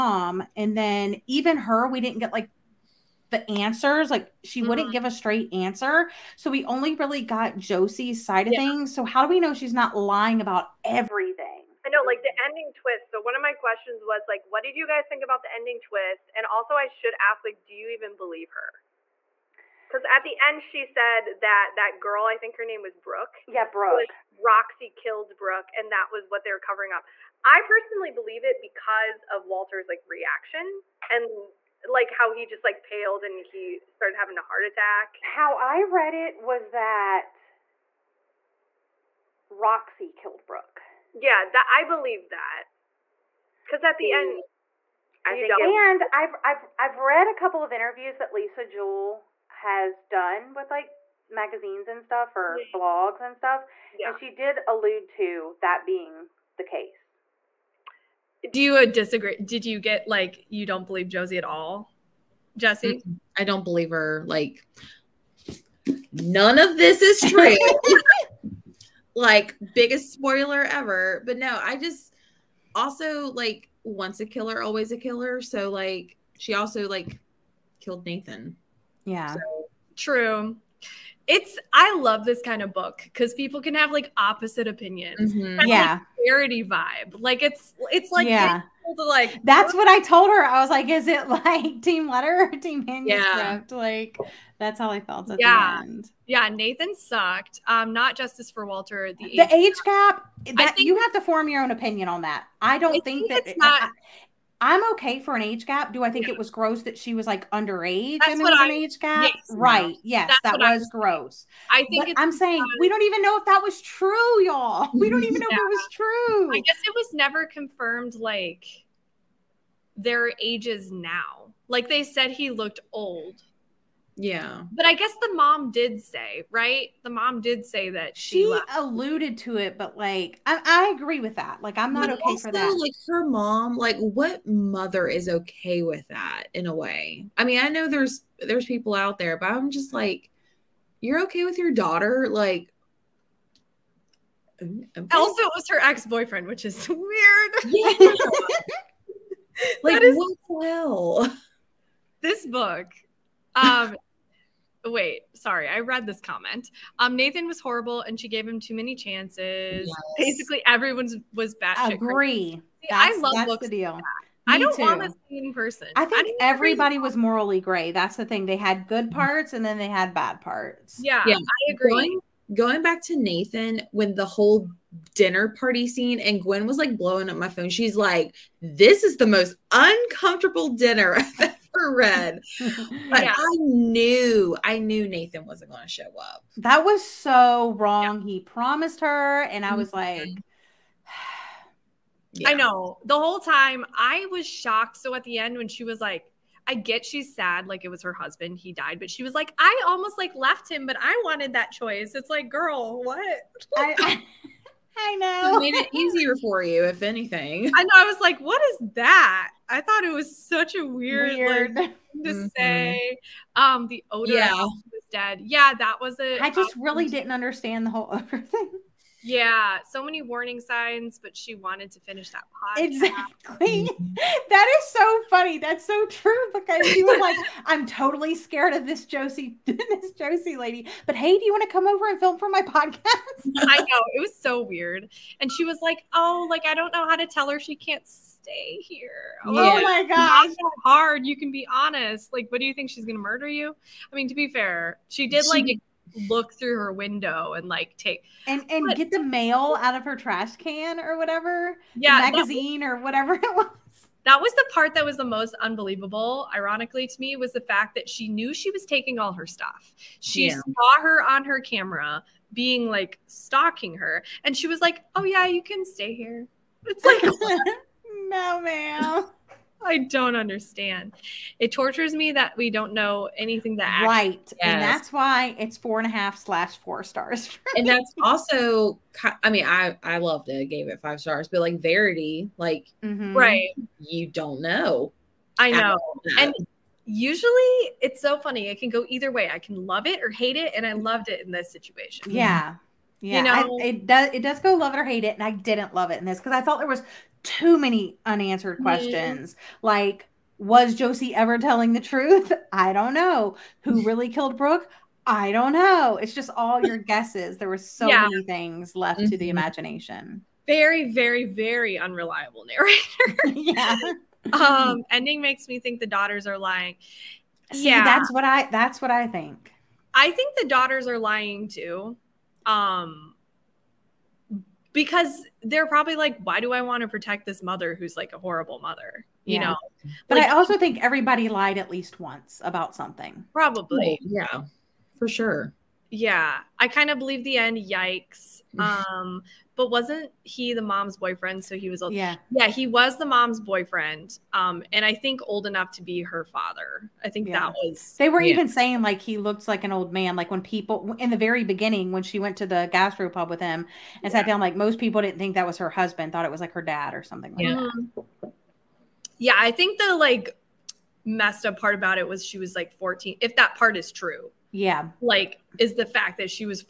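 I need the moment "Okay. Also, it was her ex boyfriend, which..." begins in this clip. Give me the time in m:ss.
2:24.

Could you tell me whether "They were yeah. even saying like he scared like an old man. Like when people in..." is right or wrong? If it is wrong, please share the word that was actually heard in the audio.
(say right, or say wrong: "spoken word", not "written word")
wrong: "looked", not "scared".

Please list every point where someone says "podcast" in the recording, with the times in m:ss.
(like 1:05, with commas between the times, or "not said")
3:42, 3:52.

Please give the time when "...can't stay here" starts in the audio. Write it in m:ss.
3:57.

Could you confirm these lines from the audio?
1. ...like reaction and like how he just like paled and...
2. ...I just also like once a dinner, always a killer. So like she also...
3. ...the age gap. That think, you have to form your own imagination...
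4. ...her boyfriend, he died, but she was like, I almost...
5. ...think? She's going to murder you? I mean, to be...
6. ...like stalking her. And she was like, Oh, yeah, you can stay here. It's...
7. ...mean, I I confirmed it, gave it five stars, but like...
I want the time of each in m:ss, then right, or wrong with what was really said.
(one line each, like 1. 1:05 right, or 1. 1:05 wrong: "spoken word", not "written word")
1. 0:29 right
2. 1:11 wrong: "killer", not "dinner"
3. 1:39 wrong: "opinion", not "imagination"
4. 3:18 wrong: "husband", not "boyfriend"
5. 4:02 right
6. 4:22 right
7. 4:39 wrong: "loved", not "confirmed".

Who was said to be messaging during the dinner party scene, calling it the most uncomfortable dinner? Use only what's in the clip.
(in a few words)
Gwen.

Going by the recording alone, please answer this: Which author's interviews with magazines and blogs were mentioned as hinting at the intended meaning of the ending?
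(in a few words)
Lisa Jewell.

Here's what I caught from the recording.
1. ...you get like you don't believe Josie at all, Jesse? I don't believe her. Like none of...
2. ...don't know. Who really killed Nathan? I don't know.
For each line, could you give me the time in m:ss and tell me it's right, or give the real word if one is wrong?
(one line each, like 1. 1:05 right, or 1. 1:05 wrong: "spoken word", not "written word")
1. 0:59 right
2. 5:02 wrong: "Brooke", not "Nathan".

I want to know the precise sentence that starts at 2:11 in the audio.
Like, I'm not but okay also, for that.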